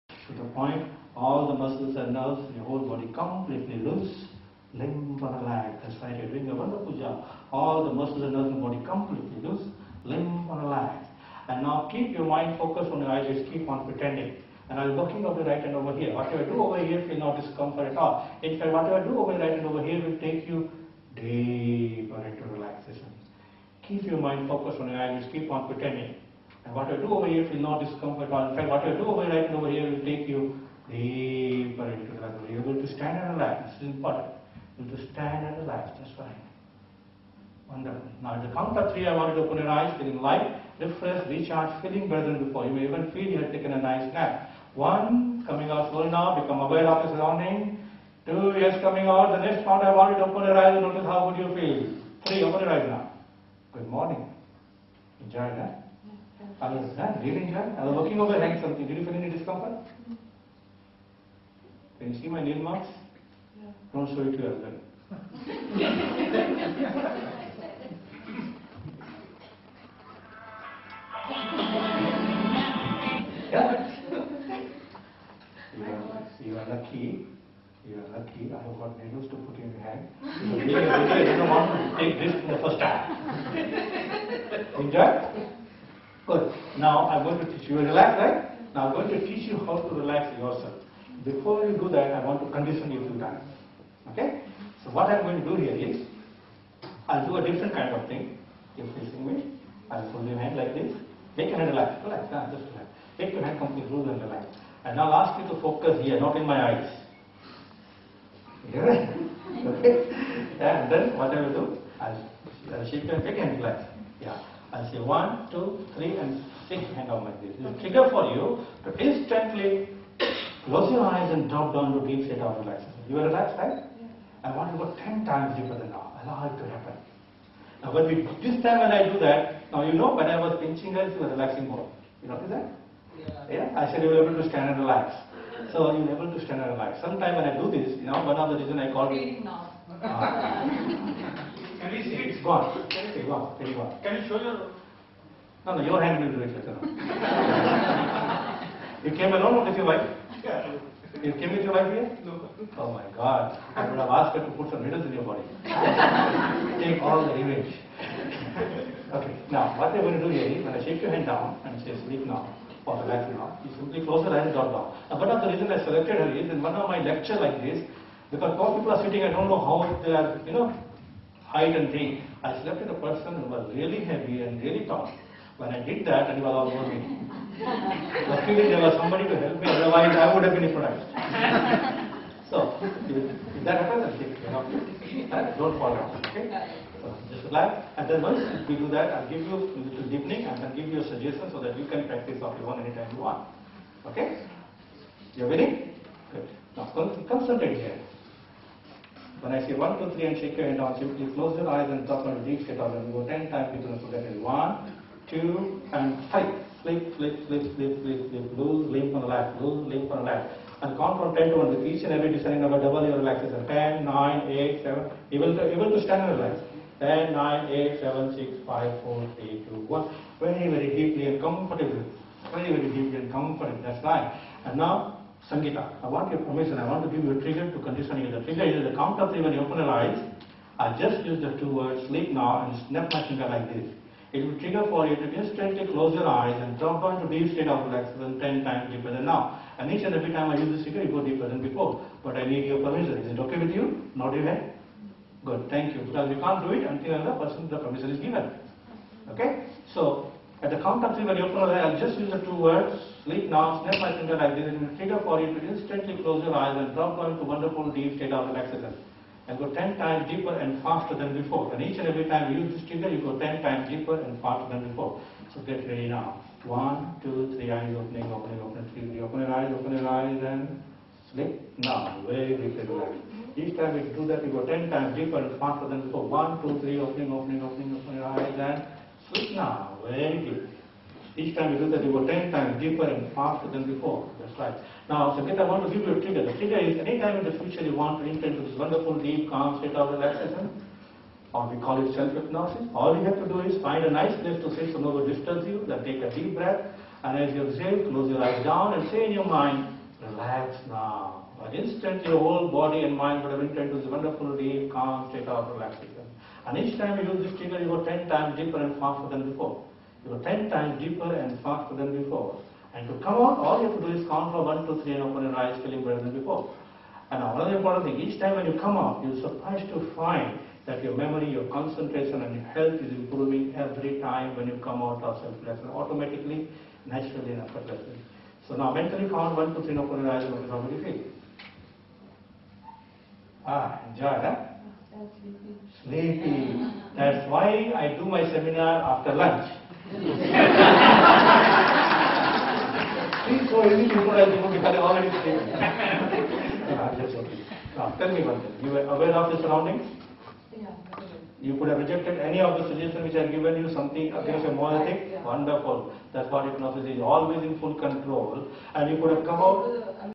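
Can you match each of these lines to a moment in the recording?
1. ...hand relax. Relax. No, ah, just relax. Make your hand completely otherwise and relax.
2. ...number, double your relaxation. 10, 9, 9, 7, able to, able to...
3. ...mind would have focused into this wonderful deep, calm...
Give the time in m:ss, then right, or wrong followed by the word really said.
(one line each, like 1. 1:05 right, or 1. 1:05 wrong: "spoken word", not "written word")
1. 1:41 wrong: "loose", not "otherwise"
2. 3:32 wrong: "8", not "9"
3. 5:03 wrong: "entered", not "focused".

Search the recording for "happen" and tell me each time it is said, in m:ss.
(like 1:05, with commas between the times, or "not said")
2:06, 3:03.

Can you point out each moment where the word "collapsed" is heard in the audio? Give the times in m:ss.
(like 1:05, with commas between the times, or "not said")
not said.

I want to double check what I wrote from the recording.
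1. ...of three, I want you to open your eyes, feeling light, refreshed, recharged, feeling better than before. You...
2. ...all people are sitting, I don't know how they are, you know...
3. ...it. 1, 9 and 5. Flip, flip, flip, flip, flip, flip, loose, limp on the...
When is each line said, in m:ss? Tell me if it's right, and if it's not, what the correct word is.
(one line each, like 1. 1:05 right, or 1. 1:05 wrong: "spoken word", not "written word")
1. 0:38 right
2. 2:48 right
3. 3:24 wrong: "2", not "9".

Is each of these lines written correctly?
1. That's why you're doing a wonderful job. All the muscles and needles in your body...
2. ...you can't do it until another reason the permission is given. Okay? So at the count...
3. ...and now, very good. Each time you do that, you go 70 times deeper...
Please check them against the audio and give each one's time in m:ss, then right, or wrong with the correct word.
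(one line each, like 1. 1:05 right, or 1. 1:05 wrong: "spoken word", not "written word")
1. 0:05 wrong: "nerves", not "needles"
2. 4:06 wrong: "person", not "reason"
3. 4:38 wrong: "10", not "70".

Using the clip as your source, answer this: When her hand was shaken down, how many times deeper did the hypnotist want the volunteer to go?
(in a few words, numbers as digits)
10.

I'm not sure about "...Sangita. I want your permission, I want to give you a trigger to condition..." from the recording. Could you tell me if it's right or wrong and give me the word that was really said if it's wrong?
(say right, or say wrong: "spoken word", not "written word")
right.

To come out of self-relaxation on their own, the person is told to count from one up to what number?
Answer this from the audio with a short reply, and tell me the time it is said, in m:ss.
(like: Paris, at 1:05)
3, at 5:14.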